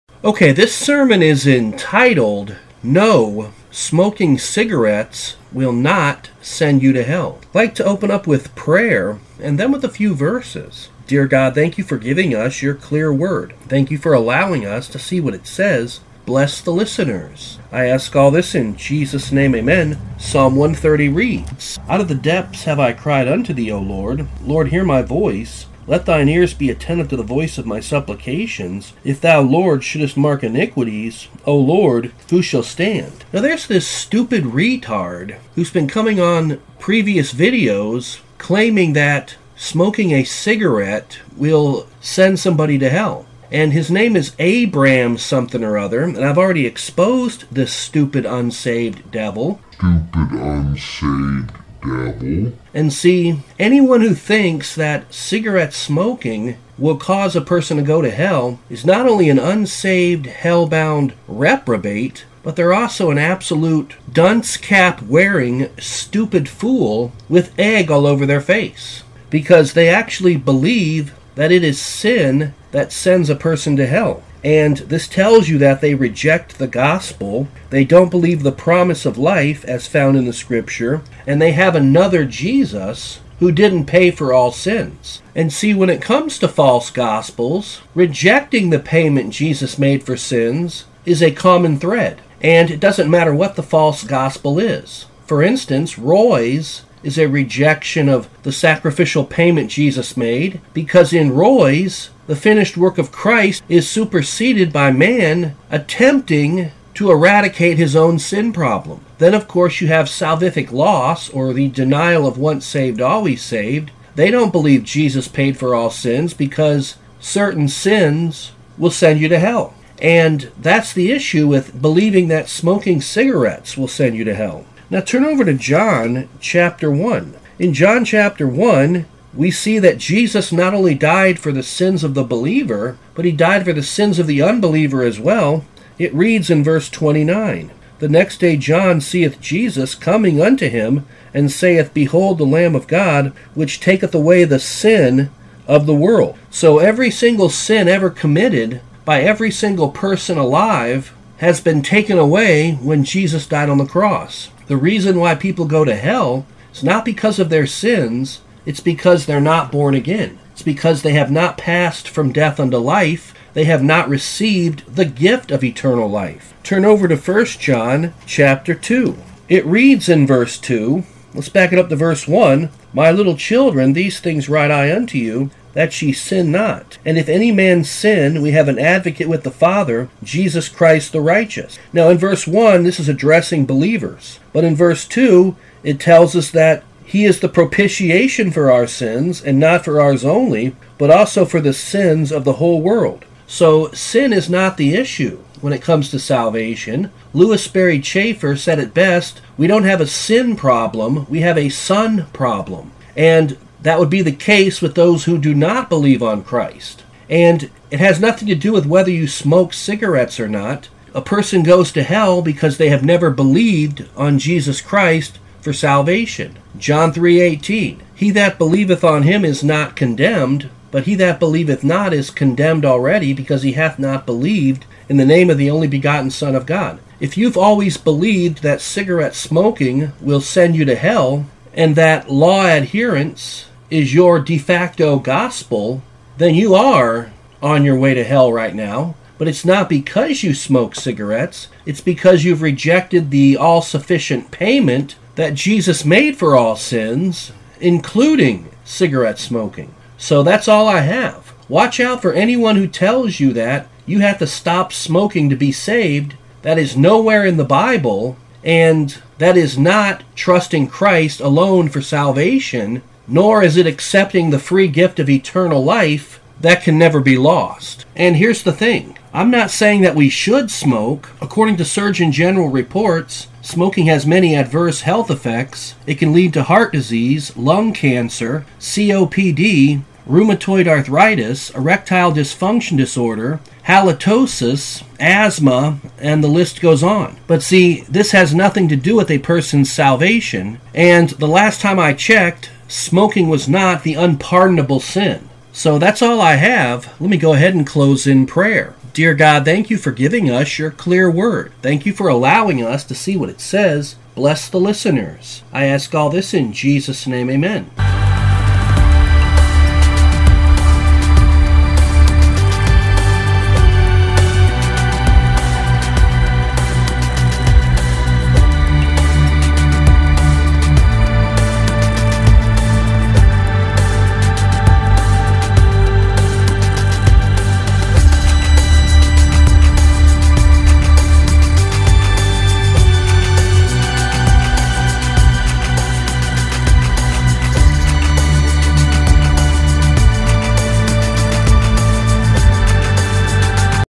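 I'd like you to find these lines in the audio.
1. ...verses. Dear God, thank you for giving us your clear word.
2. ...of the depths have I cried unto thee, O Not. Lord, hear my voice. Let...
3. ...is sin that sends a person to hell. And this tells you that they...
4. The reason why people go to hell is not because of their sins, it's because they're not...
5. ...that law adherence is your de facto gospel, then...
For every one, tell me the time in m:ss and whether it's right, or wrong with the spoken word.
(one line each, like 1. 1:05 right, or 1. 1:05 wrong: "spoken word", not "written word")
1. 0:10 right
2. 0:21 wrong: "Lord", not "Not"
3. 1:11 right
4. 2:34 right
5. 3:51 right.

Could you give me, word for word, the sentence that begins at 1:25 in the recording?
And see, when it comes to false gospels, rejecting the payment Jesus made for sins is a common thread.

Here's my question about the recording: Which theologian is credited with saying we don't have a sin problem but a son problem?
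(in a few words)
Lewis Sperry Chafer.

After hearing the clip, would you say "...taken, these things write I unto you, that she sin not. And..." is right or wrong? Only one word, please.
wrong.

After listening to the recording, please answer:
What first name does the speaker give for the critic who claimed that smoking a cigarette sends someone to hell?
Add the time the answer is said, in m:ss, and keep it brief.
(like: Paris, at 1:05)
Abram, at 0:44.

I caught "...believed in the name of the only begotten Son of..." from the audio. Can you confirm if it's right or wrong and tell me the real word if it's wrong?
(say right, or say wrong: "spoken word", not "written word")
right.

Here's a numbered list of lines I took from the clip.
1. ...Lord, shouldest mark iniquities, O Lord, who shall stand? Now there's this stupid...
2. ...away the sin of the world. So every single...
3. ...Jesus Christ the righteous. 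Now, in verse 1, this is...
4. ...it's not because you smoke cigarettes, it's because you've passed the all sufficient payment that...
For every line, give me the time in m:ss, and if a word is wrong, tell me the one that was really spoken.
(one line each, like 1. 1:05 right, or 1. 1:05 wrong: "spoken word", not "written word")
1. 0:29 right
2. 2:24 right
3. 3:00 right
4. 3:59 wrong: "rejected", not "passed".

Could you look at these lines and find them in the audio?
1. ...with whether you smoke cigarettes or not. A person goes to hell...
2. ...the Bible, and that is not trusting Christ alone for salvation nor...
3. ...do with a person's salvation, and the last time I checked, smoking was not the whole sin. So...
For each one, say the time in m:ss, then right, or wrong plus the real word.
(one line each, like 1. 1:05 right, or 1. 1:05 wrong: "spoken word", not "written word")
1. 3:28 right
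2. 4:17 right
3. 4:48 wrong: "unpardonable", not "whole".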